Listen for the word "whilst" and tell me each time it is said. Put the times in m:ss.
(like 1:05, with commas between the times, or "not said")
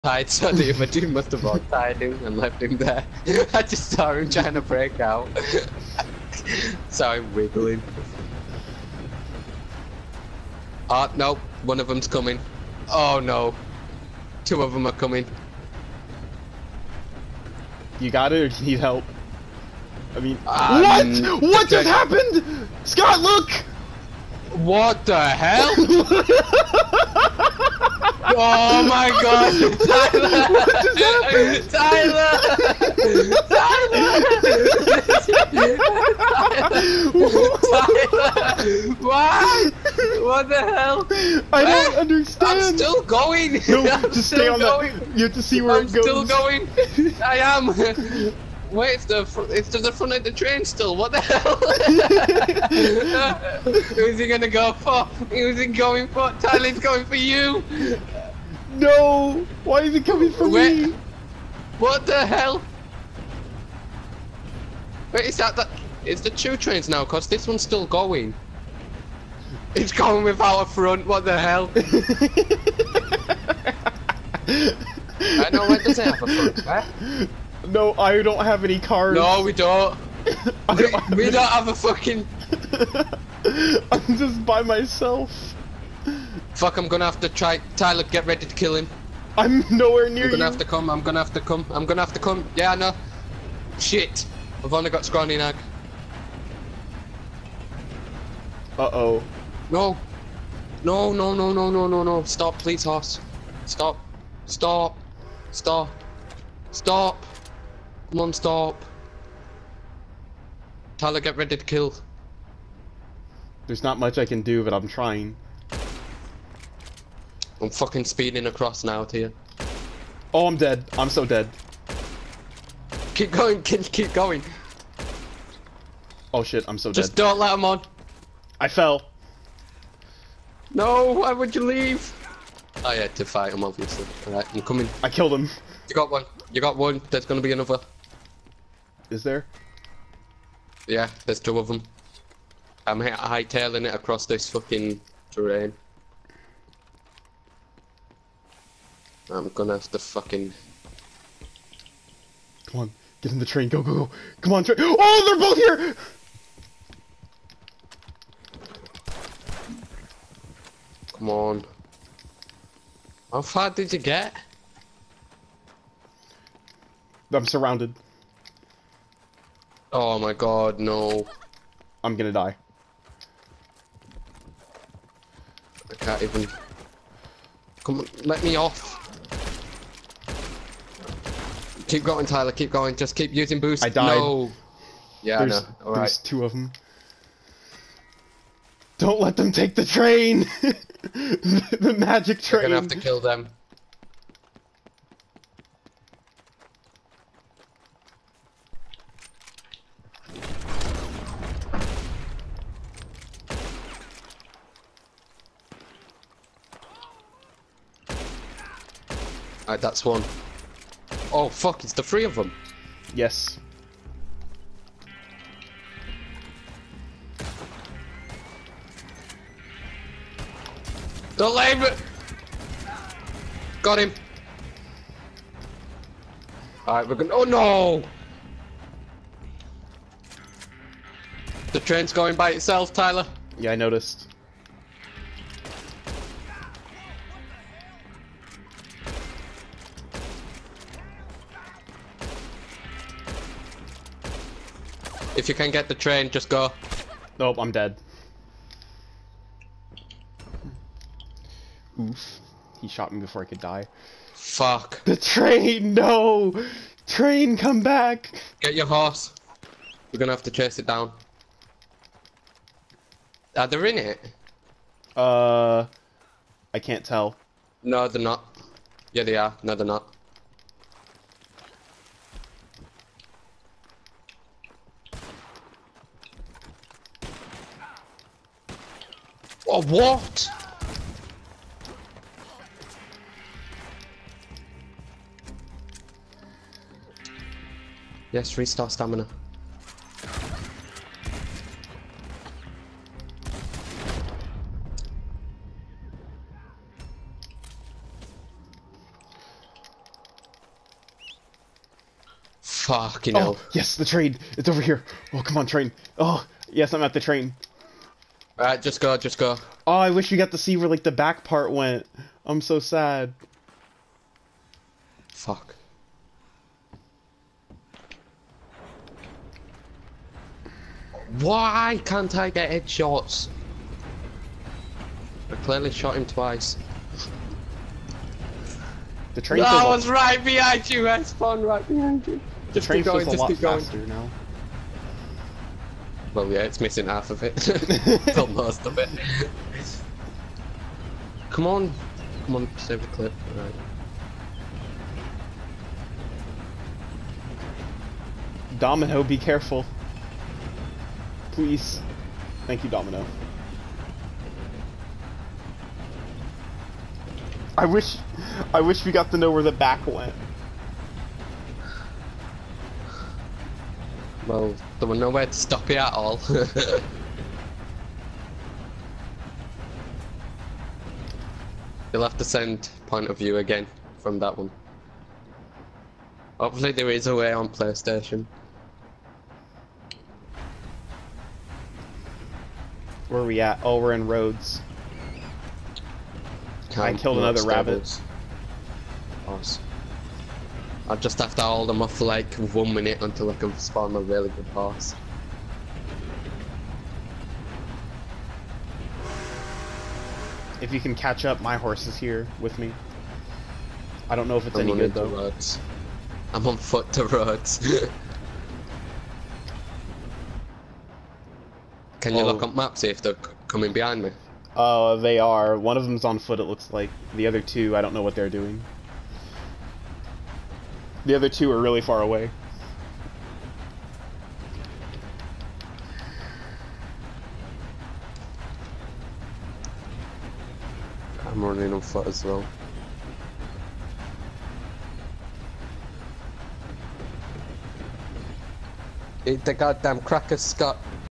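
not said.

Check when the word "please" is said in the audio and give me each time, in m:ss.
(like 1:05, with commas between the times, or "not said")
1:42, 5:51.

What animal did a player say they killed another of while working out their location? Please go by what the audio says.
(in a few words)
Rabbit.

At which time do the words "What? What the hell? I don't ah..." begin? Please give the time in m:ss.
0:38.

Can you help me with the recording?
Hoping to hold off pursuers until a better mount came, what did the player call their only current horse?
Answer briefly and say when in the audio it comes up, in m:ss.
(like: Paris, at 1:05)
Scrawny Nag, at 1:35.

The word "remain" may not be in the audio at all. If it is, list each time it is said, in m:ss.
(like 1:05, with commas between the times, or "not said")
not said.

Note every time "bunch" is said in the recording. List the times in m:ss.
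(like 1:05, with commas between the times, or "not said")
not said.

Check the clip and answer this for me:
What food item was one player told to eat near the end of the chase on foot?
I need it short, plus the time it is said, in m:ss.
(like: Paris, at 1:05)
Cracker, at 7:20.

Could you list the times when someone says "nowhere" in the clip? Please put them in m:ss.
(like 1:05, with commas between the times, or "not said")
1:29, 6:05.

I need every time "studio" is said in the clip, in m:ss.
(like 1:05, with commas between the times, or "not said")
not said.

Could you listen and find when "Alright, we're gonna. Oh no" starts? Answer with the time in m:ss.
3:46.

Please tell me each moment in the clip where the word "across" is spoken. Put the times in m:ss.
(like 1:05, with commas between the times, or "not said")
1:58, 2:23.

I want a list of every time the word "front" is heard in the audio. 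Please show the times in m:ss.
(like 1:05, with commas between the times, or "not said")
0:49, 1:10, 1:16.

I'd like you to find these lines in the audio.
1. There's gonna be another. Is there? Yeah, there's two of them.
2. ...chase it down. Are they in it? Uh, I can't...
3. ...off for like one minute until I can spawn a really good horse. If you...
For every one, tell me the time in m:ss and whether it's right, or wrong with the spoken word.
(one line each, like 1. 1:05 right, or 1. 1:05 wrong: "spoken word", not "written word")
1. 2:17 right
2. 4:20 right
3. 6:32 right.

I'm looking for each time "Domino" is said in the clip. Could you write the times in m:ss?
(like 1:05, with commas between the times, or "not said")
5:48, 5:52.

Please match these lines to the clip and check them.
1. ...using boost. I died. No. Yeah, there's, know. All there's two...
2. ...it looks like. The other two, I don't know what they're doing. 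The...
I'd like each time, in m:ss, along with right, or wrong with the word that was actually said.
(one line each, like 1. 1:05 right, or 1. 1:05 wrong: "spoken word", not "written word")
1. 3:03 right
2. 6:56 right.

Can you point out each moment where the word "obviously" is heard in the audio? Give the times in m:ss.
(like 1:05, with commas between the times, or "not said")
2:13.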